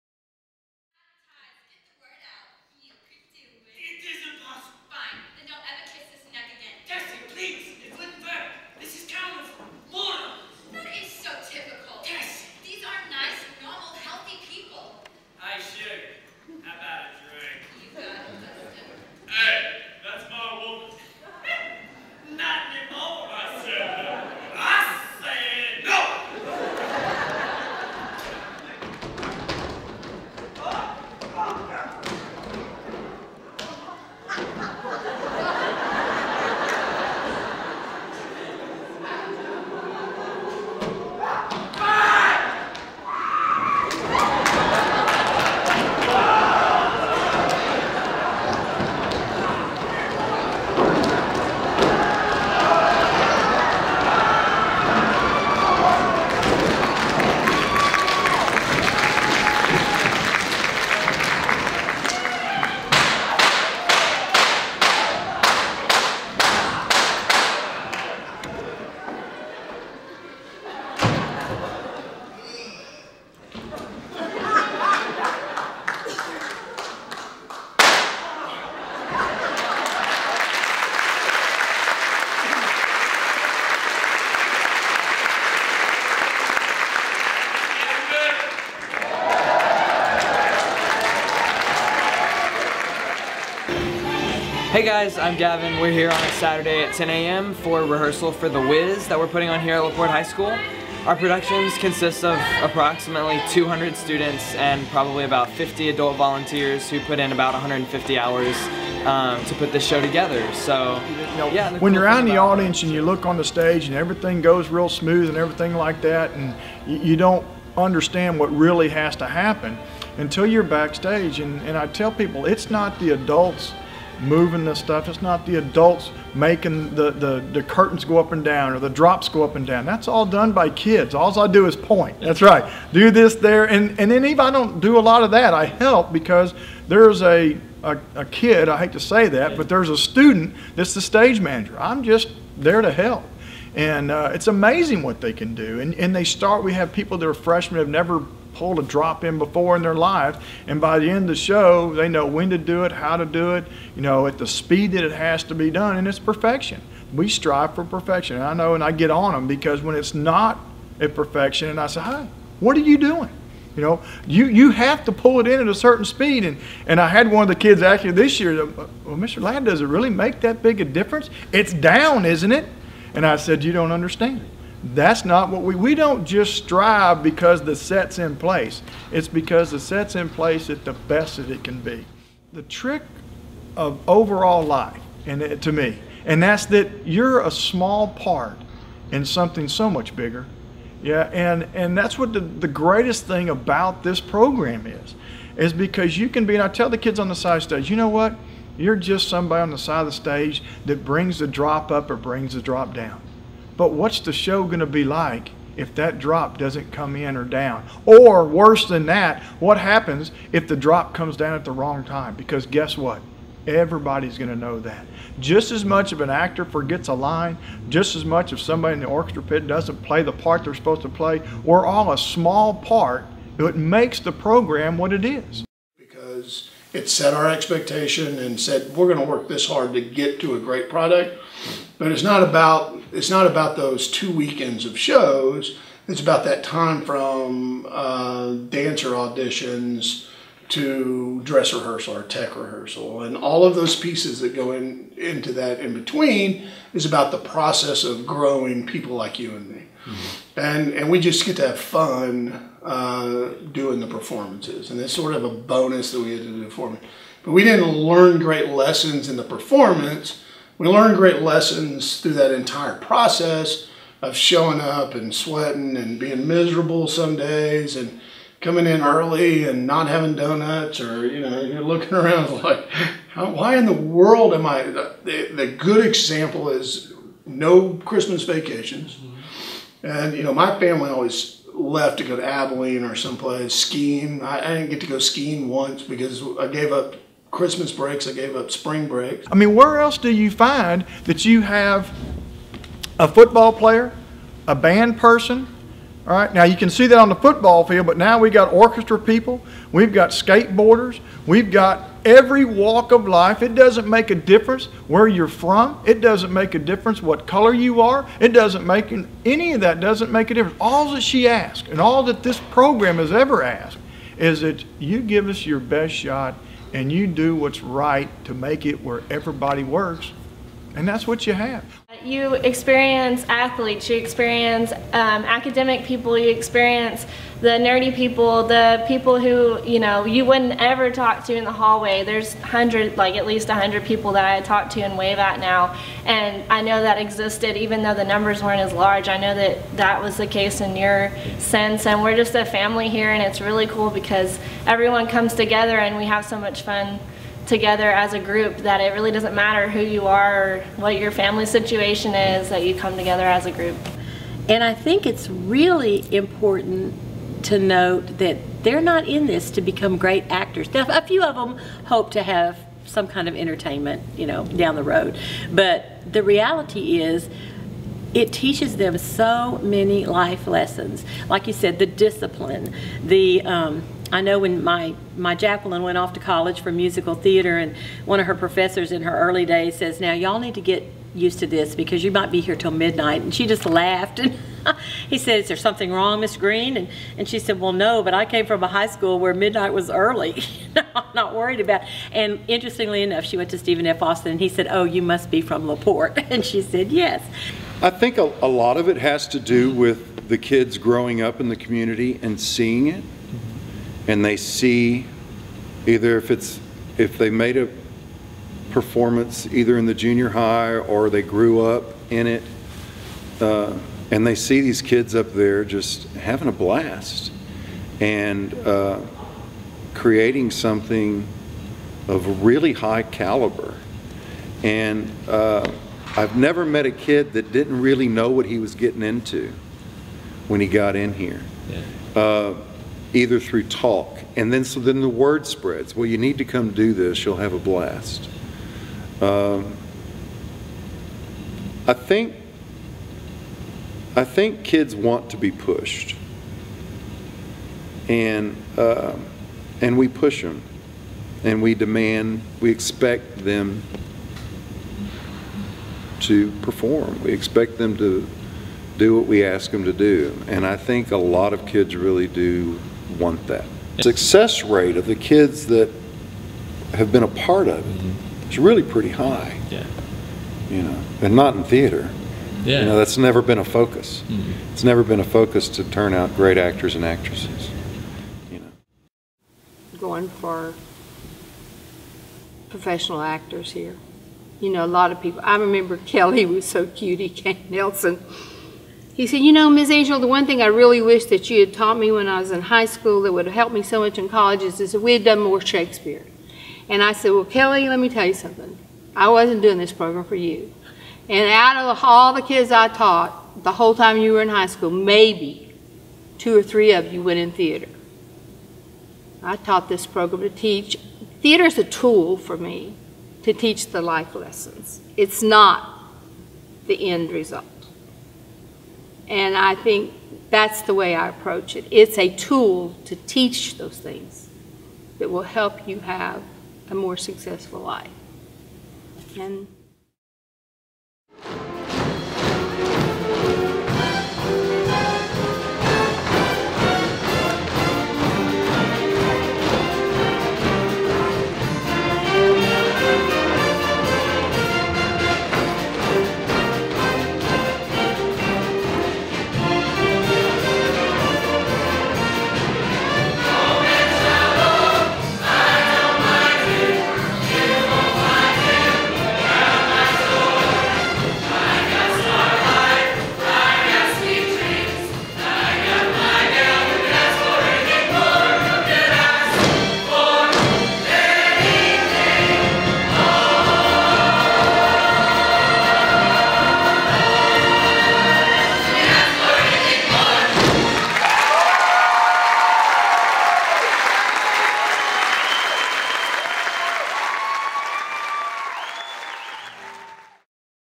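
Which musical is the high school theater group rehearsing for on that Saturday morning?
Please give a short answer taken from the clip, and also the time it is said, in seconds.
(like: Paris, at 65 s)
The Wiz, at 98 s.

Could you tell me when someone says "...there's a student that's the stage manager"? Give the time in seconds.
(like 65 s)
139 s.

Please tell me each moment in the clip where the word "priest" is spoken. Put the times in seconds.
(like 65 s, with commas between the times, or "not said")
not said.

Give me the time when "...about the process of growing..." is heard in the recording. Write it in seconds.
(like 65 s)
247 s.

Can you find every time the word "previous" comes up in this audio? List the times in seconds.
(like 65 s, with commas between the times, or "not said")
not said.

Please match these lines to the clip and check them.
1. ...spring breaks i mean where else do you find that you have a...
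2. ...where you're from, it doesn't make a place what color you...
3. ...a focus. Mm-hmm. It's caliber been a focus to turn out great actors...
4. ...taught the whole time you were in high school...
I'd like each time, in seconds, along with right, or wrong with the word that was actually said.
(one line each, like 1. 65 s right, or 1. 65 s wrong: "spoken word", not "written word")
1. 288 s right
2. 305 s wrong: "difference", not "place"
3. 473 s wrong: "never", not "caliber"
4. 503 s right.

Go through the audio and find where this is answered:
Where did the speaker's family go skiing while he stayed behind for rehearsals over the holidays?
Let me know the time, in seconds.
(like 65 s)
282 s.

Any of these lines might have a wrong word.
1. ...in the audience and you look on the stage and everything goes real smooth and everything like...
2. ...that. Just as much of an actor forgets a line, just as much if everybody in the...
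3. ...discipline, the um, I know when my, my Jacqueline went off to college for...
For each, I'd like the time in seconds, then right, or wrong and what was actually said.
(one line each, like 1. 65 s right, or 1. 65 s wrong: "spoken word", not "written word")
1. 112 s right
2. 214 s wrong: "somebody", not "everybody"
3. 372 s right.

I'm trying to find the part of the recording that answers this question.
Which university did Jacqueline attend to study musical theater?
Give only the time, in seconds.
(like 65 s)
393 s.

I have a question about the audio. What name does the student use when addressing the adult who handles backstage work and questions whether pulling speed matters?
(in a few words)
Mr. Ladd.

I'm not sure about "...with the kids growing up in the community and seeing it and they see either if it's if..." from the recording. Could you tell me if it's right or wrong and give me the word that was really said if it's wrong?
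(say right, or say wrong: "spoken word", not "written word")
right.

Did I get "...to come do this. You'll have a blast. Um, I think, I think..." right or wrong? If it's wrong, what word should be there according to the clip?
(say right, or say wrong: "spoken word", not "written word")
right.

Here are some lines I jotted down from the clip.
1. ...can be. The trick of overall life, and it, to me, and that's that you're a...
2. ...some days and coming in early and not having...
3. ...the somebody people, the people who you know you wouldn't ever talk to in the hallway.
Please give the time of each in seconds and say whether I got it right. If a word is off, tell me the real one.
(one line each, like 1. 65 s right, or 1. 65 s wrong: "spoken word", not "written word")
1. 181 s right
2. 267 s right
3. 327 s wrong: "nerdy", not "somebody".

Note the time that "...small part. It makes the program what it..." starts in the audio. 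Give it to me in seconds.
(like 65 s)
222 s.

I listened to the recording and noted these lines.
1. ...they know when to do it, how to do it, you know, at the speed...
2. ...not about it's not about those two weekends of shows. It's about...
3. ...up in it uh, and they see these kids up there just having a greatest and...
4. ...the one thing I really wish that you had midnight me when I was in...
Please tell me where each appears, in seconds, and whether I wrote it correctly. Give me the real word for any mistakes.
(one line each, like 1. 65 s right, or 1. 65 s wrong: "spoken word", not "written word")
1. 151 s right
2. 232 s right
3. 411 s wrong: "blast", not "greatest"
4. 490 s wrong: "taught", not "midnight".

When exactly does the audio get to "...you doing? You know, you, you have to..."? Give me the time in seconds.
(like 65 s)
162 s.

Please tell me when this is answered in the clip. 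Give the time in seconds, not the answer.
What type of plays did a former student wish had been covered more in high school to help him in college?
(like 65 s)
495 s.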